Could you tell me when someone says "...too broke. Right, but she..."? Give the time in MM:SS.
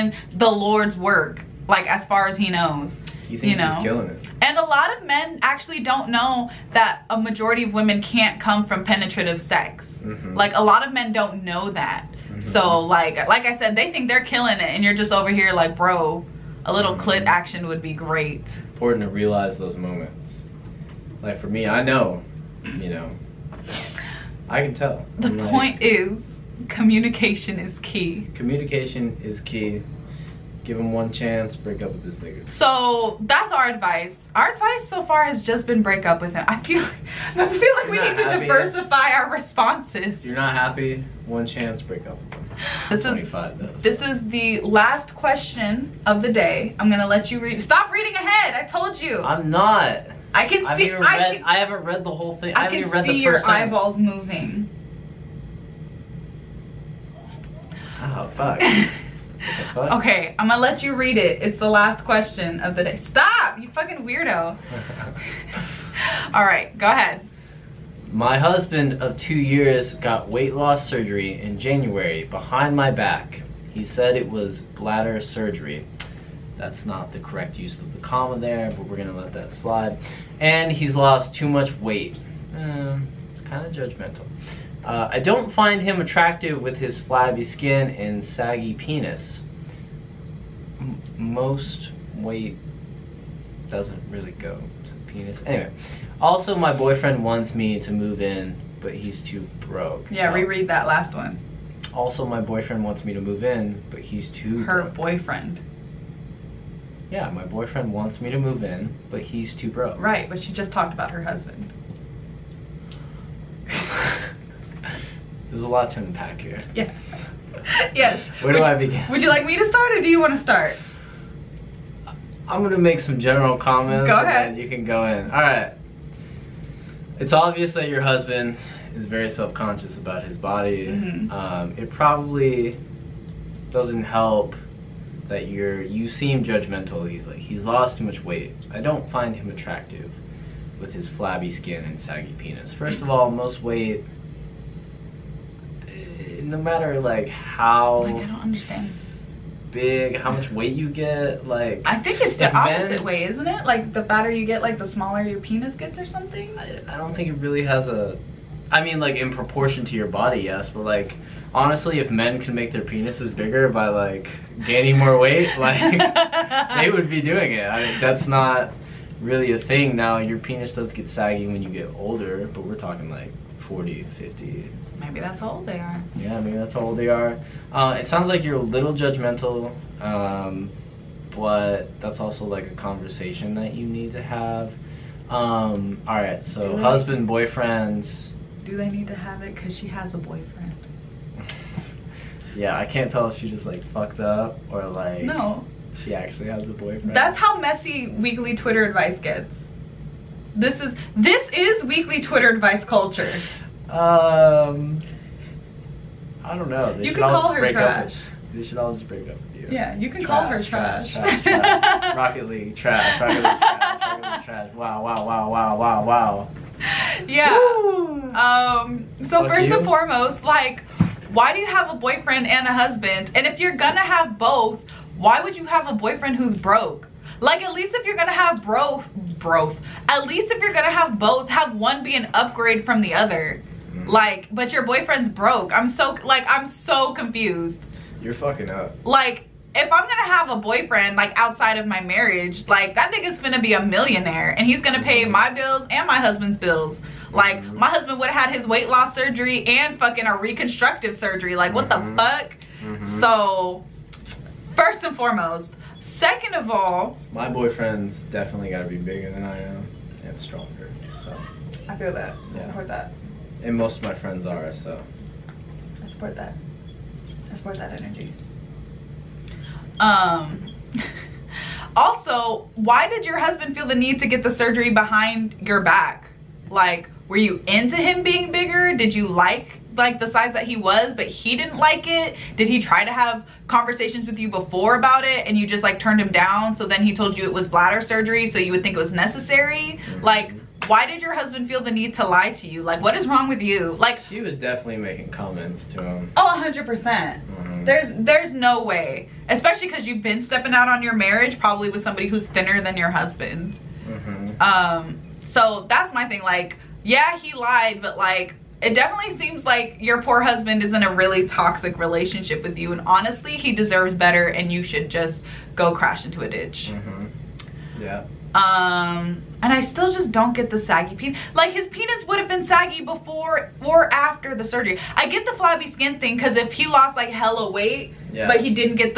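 01:49.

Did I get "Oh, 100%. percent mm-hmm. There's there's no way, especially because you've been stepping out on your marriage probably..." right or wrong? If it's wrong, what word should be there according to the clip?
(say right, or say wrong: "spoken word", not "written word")
right.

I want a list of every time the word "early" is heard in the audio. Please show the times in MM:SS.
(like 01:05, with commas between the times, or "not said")
not said.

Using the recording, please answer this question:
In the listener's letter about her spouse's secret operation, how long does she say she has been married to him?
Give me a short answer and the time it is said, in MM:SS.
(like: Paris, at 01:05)
2 years, at 01:09.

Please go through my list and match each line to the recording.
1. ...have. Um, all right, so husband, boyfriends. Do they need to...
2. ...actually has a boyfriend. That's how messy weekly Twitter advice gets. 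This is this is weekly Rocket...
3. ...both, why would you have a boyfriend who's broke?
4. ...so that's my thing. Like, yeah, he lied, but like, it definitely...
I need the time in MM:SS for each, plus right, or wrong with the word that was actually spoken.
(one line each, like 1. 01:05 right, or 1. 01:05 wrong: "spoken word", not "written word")
1. 03:04 right
2. 03:16 wrong: "Twitter", not "Rocket"
3. 03:44 right
4. 05:05 right.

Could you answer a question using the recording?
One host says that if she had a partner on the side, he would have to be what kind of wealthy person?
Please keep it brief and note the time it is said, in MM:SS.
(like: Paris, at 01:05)
millionaire, at 04:03.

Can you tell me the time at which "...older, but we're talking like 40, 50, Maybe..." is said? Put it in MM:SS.
02:51.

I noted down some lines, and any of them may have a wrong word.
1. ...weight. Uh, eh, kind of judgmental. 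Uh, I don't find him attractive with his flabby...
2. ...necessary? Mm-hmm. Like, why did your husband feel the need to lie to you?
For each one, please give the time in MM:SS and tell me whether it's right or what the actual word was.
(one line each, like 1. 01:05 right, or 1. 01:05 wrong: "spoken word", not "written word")
1. 01:21 right
2. 04:49 right.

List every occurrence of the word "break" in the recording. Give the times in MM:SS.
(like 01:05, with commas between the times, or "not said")
00:31, 00:35, 00:41, 03:29.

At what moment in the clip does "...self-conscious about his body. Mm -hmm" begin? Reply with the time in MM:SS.
02:09.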